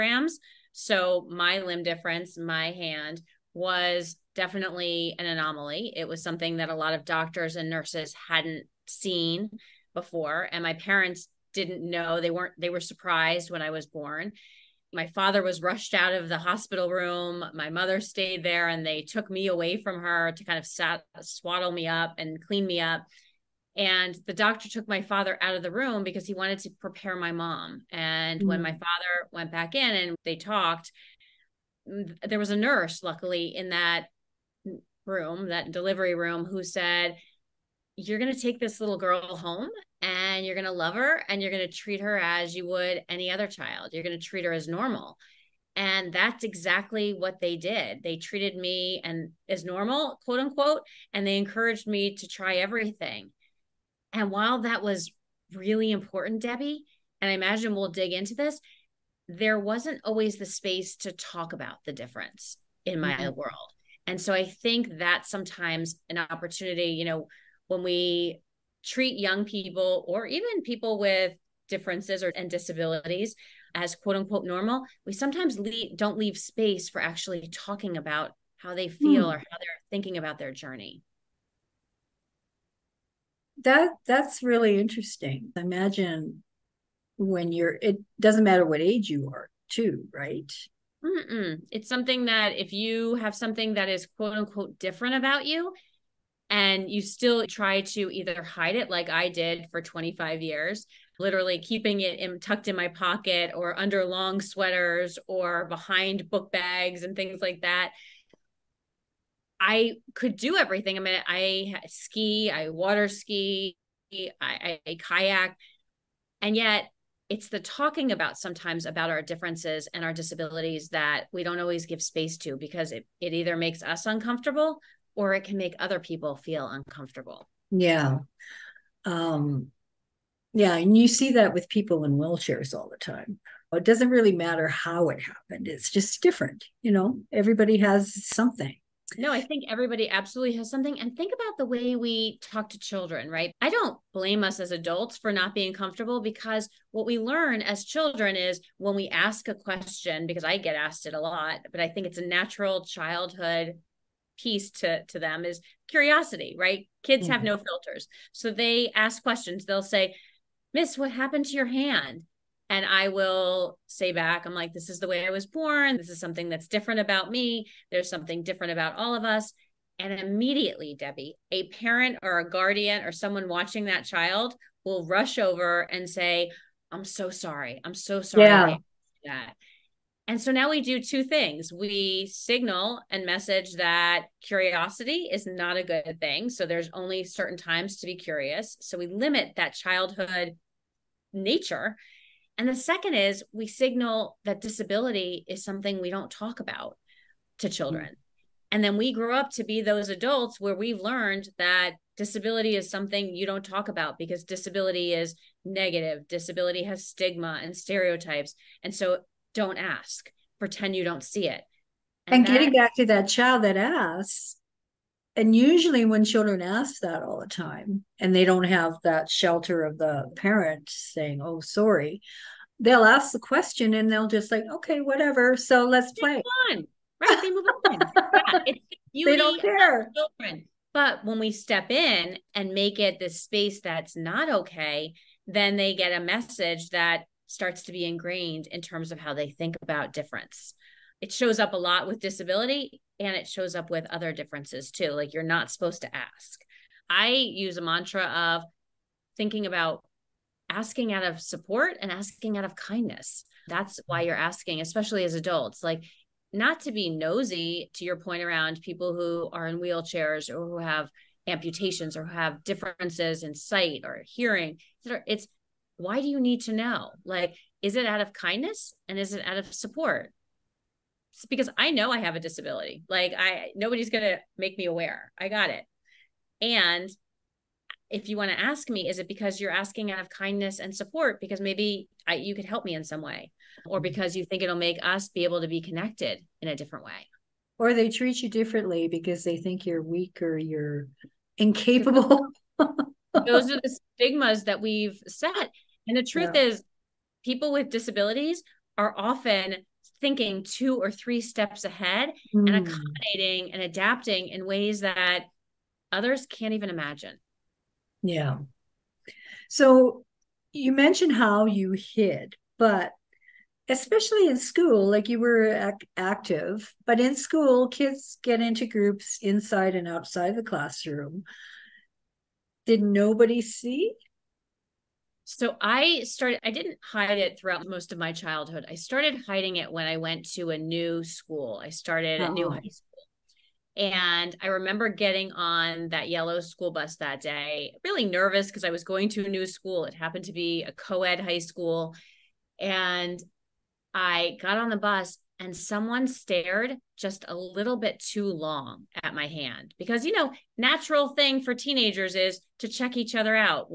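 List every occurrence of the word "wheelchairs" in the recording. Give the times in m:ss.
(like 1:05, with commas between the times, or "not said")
2:12, 4:19.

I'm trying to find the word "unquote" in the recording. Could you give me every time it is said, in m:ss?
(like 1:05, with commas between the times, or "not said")
0:50, 1:14, 1:34.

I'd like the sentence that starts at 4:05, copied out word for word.
Like you're not supposed to ask.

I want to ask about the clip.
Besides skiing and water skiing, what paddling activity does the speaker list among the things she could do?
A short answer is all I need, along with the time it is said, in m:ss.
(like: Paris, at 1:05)
Kayak, at 1:54.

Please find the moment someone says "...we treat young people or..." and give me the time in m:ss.
1:07.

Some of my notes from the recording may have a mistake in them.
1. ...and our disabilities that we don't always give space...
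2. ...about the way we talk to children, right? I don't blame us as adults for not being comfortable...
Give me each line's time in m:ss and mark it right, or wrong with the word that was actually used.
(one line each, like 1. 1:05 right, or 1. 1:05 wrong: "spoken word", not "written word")
1. 1:59 right
2. 2:21 right.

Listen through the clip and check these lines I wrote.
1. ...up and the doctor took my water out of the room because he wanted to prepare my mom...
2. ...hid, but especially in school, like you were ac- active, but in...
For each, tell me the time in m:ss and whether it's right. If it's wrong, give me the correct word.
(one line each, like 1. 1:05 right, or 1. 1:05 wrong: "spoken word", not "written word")
1. 0:22 wrong: "father", not "water"
2. 5:11 right.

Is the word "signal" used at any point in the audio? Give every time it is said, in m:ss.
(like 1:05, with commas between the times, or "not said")
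3:02, 3:13.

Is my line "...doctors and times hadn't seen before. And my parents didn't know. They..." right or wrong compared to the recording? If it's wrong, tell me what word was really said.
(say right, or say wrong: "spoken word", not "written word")
wrong: "nurses", not "times".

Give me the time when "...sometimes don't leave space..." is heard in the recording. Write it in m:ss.
1:15.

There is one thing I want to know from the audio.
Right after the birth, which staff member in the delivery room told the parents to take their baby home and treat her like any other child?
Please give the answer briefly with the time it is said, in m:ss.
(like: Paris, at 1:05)
A nurse, at 0:32.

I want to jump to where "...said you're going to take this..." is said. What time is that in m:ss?
0:36.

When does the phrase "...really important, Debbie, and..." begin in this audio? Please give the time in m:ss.
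0:55.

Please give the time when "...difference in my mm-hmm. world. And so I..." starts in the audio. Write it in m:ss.
1:01.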